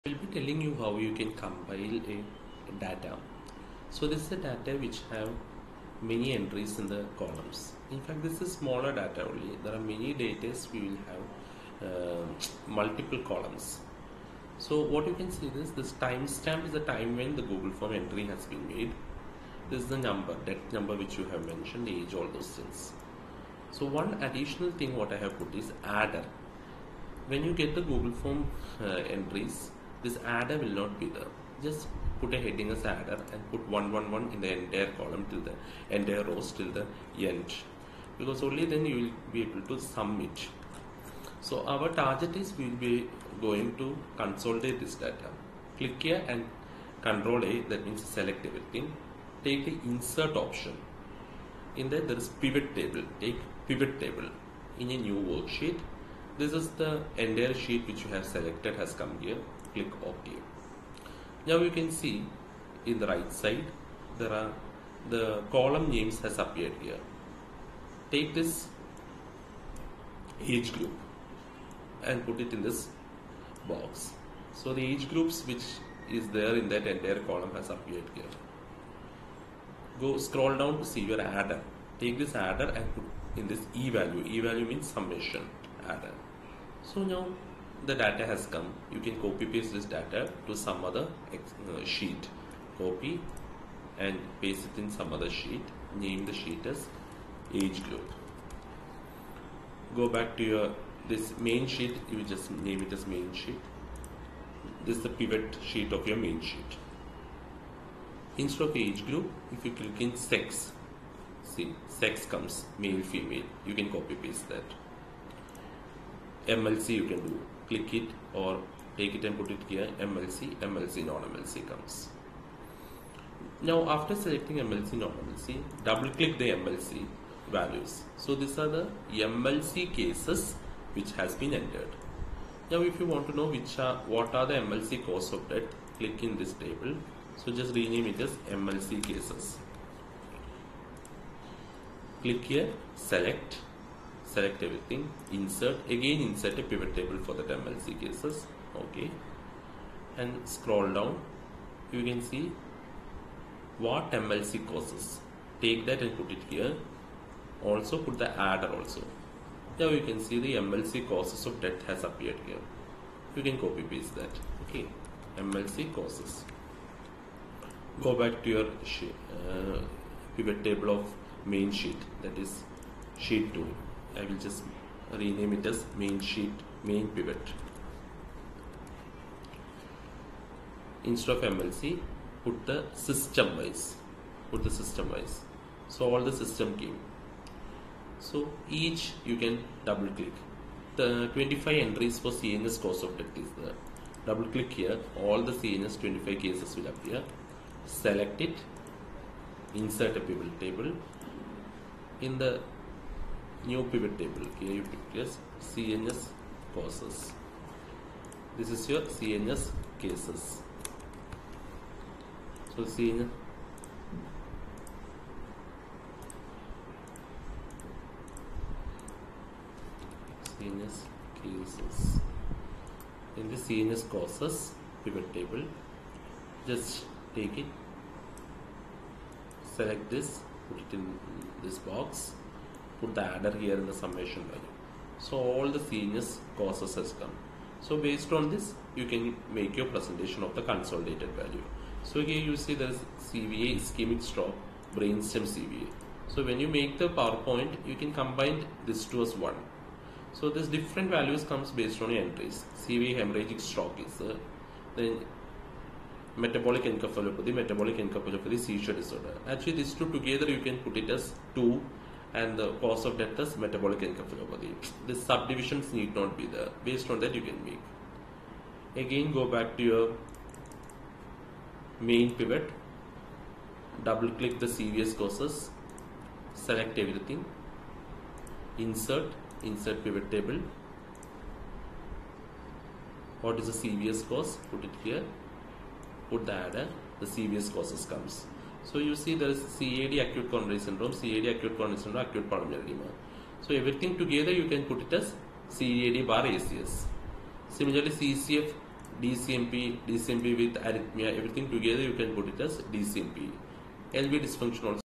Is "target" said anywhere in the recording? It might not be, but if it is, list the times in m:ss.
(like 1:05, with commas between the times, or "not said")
0:42.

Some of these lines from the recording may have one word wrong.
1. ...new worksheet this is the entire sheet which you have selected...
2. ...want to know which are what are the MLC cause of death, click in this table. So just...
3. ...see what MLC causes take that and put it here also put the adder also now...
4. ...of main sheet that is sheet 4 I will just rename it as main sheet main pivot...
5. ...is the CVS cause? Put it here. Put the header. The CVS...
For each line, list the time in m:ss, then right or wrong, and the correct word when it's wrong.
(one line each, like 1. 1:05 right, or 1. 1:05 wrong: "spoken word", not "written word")
1. 0:55 right
2. 2:13 right
3. 2:32 right
4. 2:50 wrong: "2", not "4"
5. 4:43 right.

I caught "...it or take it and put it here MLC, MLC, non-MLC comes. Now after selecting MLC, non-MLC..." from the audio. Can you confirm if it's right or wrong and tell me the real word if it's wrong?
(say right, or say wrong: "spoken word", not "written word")
right.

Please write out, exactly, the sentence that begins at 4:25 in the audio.
The subdivisions need not be there.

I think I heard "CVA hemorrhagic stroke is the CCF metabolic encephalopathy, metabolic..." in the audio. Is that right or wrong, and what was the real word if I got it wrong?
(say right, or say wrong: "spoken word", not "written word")
wrong: "Then", not "CCF".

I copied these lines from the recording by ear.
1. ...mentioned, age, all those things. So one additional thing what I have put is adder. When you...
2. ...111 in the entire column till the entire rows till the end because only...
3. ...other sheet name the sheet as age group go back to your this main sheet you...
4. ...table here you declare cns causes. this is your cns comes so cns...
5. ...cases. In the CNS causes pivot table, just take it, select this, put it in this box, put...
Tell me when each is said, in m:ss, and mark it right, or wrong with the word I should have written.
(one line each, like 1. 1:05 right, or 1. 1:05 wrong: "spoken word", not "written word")
1. 0:21 right
2. 0:33 right
3. 1:35 right
4. 3:24 wrong: "cases", not "comes"
5. 3:41 right.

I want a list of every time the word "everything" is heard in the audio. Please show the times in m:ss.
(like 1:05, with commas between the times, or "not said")
0:48, 2:24, 4:36, 4:53, 5:01.